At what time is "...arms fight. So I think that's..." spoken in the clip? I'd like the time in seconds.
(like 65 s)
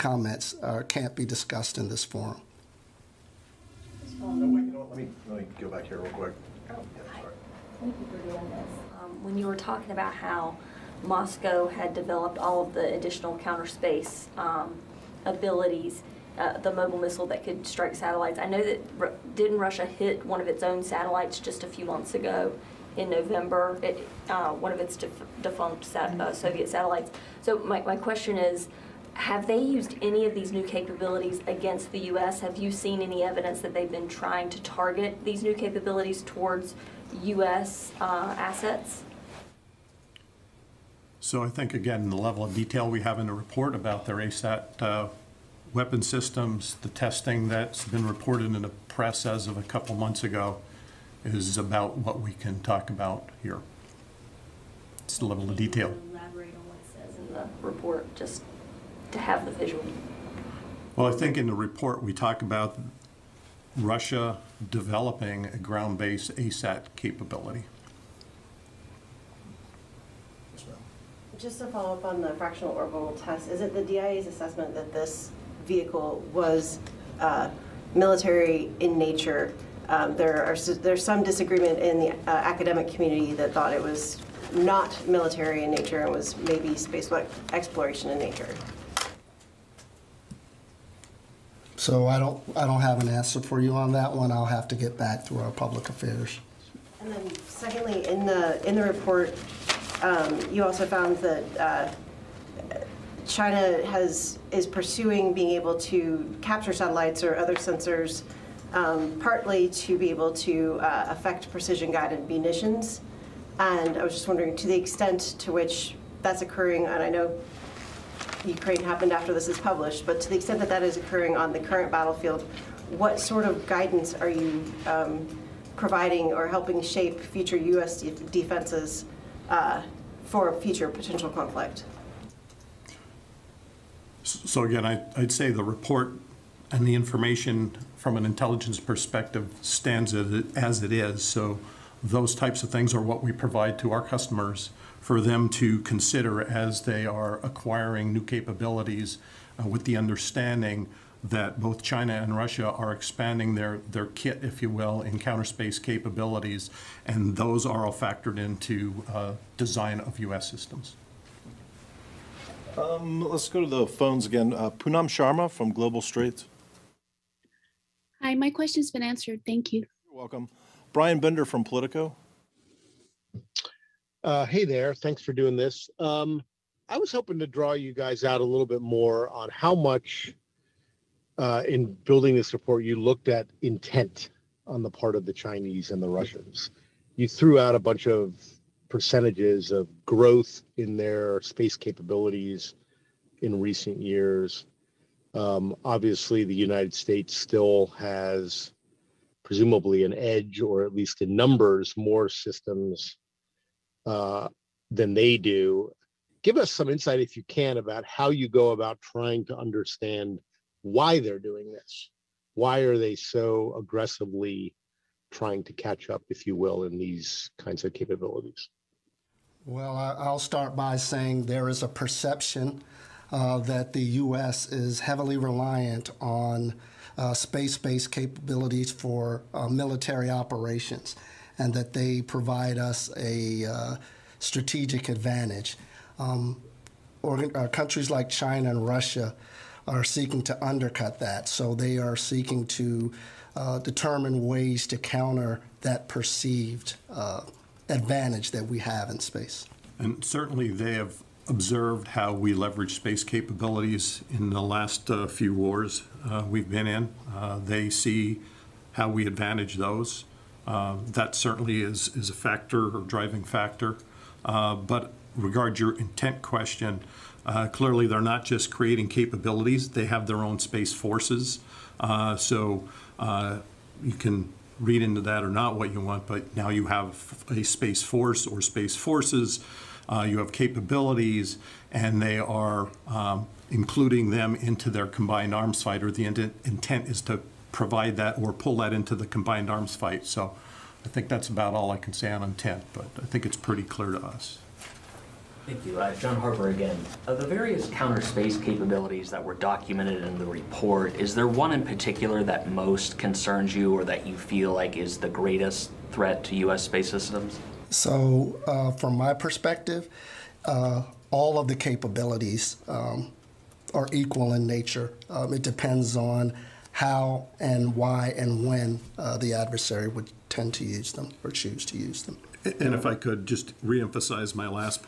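289 s.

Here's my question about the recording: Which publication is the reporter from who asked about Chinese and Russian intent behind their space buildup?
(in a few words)
Politico.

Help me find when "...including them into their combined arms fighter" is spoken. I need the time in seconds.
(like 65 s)
283 s.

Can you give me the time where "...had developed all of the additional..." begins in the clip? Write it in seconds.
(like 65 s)
11 s.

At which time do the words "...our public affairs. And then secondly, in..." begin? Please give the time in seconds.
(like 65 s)
95 s.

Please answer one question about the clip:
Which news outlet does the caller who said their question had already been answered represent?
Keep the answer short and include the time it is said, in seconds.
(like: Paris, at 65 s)
Global Straits, at 165 s.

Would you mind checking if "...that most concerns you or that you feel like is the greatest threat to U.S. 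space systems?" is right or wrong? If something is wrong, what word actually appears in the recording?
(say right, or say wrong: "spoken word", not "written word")
right.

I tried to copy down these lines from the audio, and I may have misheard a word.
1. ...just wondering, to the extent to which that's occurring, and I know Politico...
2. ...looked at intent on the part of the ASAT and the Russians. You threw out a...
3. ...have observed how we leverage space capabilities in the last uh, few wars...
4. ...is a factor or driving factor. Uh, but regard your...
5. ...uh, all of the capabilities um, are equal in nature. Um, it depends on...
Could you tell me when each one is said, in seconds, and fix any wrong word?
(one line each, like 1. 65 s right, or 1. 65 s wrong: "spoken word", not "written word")
1. 114 s wrong: "Ukraine", not "Politico"
2. 182 s wrong: "Chinese", not "ASAT"
3. 250 s right
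4. 262 s right
5. 310 s right.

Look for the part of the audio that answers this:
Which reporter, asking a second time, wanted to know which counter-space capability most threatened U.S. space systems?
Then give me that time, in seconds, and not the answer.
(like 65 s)
296 s.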